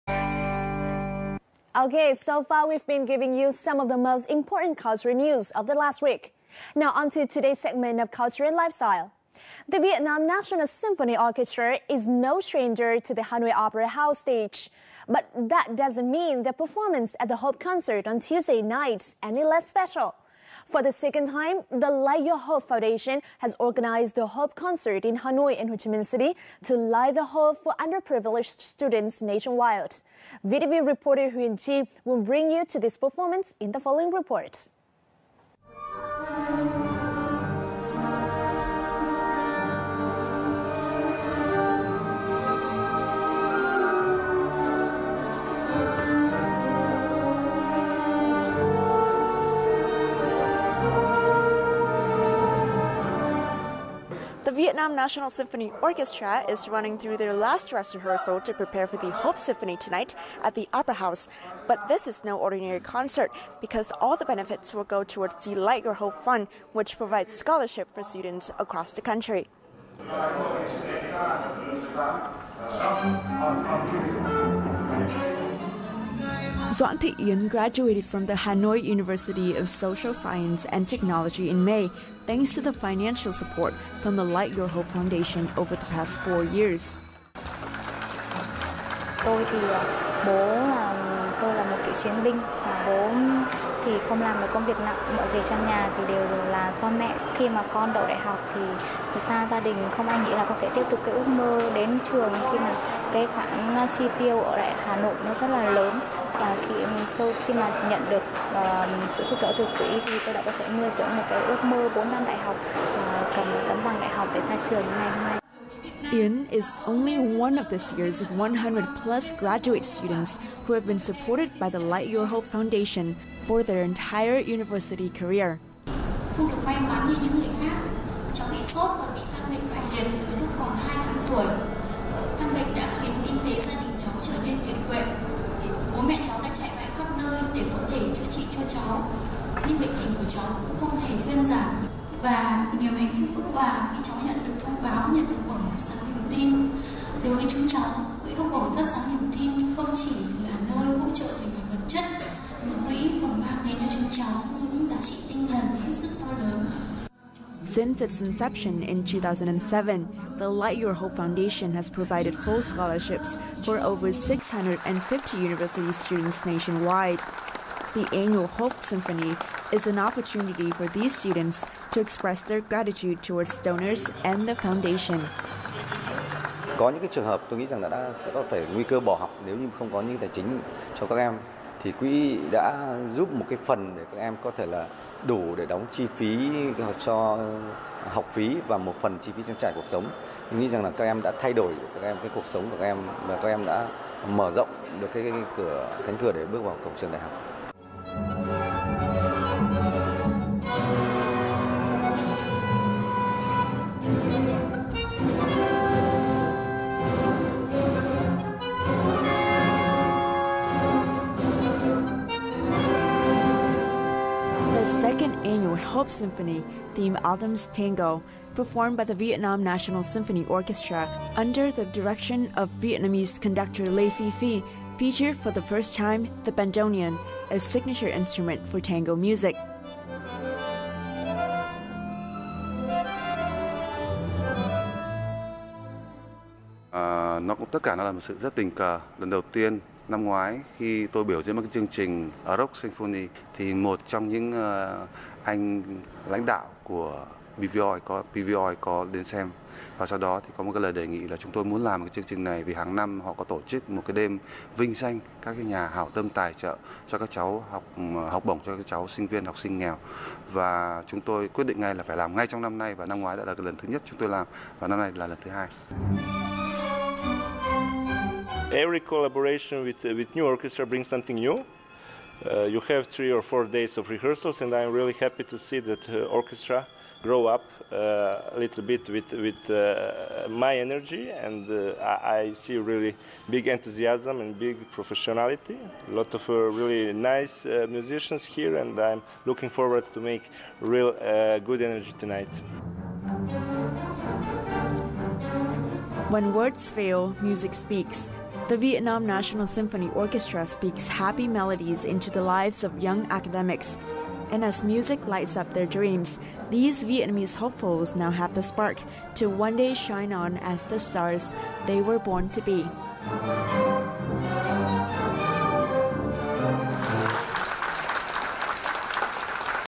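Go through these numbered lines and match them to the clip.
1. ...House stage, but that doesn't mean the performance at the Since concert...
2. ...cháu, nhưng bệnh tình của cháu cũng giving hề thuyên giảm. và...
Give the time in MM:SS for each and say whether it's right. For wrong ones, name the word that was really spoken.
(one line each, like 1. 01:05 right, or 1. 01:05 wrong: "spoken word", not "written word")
1. 00:13 wrong: "Hope", not "Since"
2. 02:18 wrong: "không", not "giving".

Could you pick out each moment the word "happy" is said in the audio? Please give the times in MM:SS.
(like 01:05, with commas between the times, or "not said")
04:35, 05:01.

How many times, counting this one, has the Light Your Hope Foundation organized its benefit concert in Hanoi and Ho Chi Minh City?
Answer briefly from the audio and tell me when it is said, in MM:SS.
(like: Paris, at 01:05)
second time, at 00:20.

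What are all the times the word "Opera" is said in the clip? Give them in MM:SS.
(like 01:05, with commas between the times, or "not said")
00:13, 01:00.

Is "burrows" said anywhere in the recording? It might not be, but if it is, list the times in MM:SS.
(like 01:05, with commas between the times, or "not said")
not said.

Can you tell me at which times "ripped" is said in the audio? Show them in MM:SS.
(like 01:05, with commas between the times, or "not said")
not said.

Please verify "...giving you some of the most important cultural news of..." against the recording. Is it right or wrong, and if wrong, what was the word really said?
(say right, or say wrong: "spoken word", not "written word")
right.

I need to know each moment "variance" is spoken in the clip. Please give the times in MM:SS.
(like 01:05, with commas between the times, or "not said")
not said.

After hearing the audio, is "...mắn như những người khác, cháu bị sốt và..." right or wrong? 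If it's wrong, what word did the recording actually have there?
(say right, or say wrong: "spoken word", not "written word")
right.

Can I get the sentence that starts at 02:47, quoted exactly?
The annual Hope Symphony is an opportunity for these students to express their gratitude towards donors and the foundation.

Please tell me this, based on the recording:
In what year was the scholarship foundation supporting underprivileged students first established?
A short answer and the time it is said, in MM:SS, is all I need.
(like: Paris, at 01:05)
2007, at 02:39.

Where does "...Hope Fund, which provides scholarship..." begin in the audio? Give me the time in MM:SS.
01:05.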